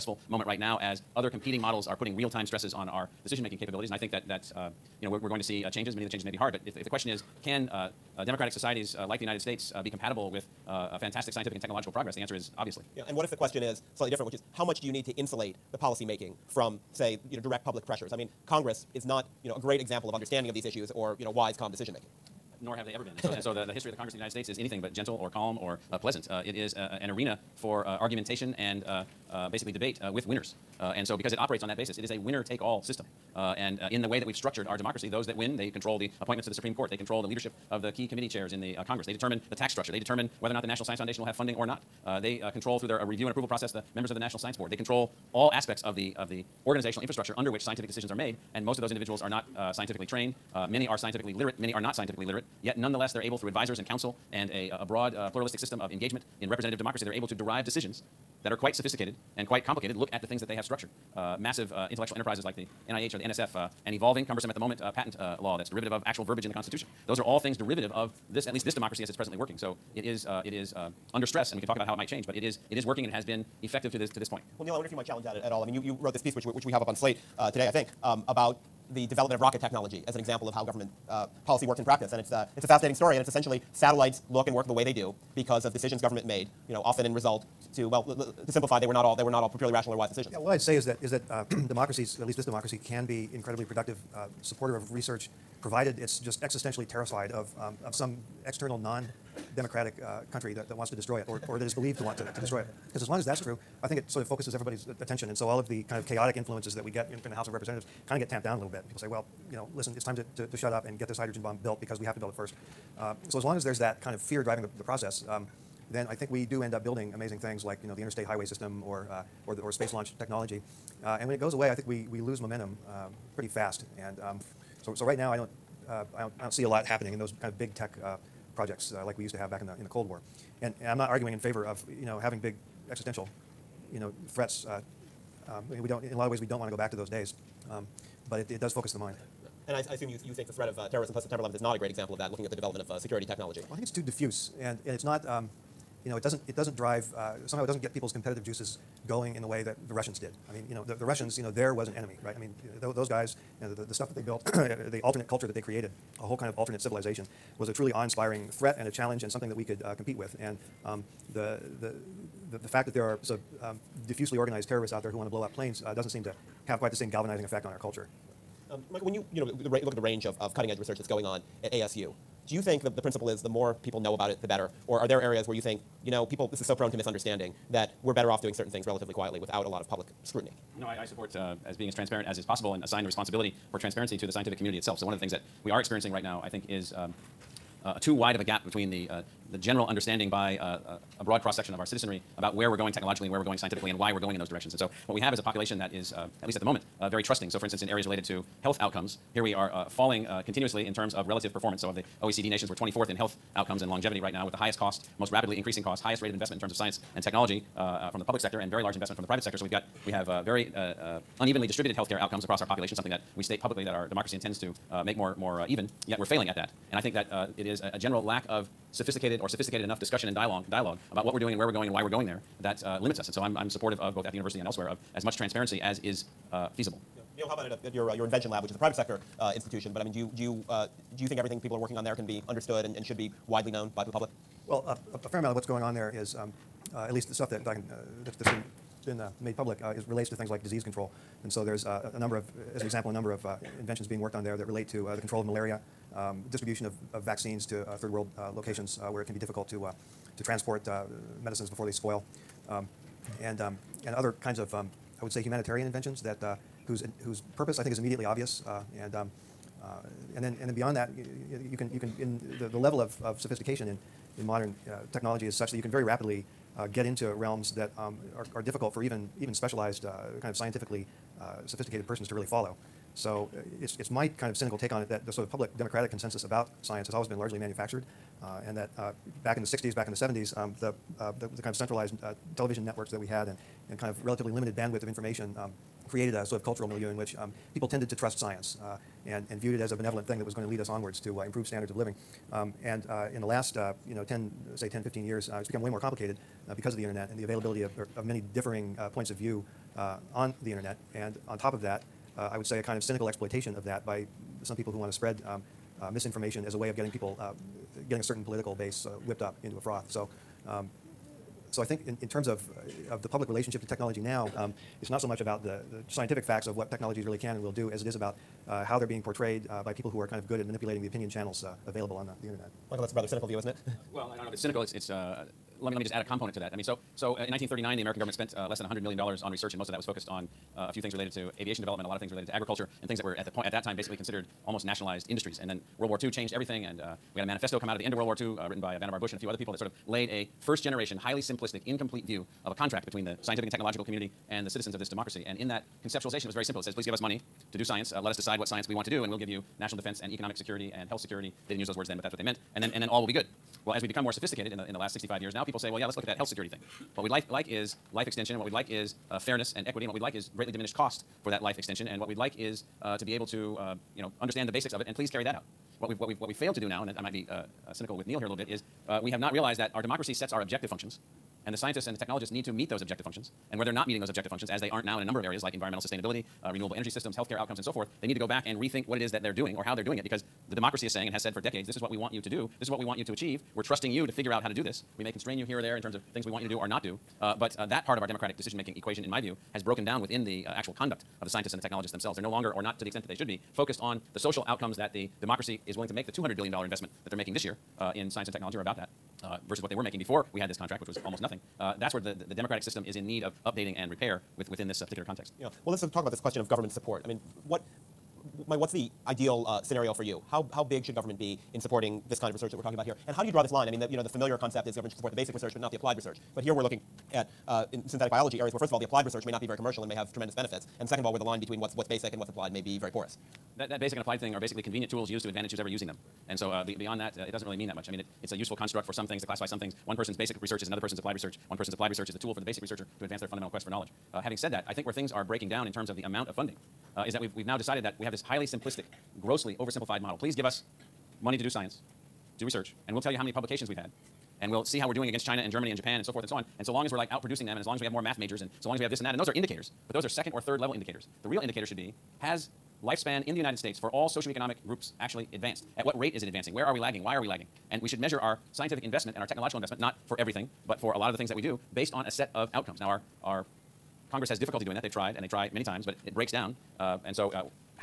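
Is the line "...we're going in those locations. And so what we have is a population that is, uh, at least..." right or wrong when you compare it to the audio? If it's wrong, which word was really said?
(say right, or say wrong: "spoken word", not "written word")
wrong: "directions", not "locations".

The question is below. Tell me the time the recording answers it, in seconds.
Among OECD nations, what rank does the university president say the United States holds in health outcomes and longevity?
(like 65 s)
202 s.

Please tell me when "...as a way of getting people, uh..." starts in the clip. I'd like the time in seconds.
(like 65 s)
306 s.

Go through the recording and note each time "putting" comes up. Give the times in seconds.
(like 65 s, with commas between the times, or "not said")
1 s.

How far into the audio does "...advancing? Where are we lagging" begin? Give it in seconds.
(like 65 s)
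456 s.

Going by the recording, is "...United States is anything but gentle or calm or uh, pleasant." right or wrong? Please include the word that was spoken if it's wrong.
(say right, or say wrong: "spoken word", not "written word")
right.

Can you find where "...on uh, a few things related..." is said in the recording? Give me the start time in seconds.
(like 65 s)
330 s.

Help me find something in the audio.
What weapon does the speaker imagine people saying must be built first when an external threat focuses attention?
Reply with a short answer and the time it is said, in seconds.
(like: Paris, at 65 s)
hydrogen bomb, at 111 s.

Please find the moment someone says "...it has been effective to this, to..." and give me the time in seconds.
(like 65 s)
73 s.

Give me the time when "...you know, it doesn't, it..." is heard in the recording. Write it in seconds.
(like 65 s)
146 s.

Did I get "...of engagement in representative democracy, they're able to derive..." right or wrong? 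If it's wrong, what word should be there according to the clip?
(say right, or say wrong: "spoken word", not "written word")
right.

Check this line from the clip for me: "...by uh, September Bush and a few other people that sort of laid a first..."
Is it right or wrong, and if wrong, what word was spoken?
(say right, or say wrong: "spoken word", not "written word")
wrong: "Vannevar", not "September".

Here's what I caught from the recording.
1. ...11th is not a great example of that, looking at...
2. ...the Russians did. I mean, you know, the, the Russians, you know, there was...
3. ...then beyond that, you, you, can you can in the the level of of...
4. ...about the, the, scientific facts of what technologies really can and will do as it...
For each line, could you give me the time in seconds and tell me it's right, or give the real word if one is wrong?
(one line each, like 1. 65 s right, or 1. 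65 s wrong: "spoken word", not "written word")
1. 141 s right
2. 149 s right
3. 260 s right
4. 315 s right.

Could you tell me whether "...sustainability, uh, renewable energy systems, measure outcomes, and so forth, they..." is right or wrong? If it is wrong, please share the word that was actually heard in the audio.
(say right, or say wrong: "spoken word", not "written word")
wrong: "healthcare", not "measure".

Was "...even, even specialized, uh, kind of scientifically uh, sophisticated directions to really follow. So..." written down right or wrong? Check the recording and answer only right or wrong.
wrong.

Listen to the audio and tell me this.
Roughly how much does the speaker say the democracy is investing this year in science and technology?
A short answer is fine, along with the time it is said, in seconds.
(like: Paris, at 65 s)
$200 billion, at 396 s.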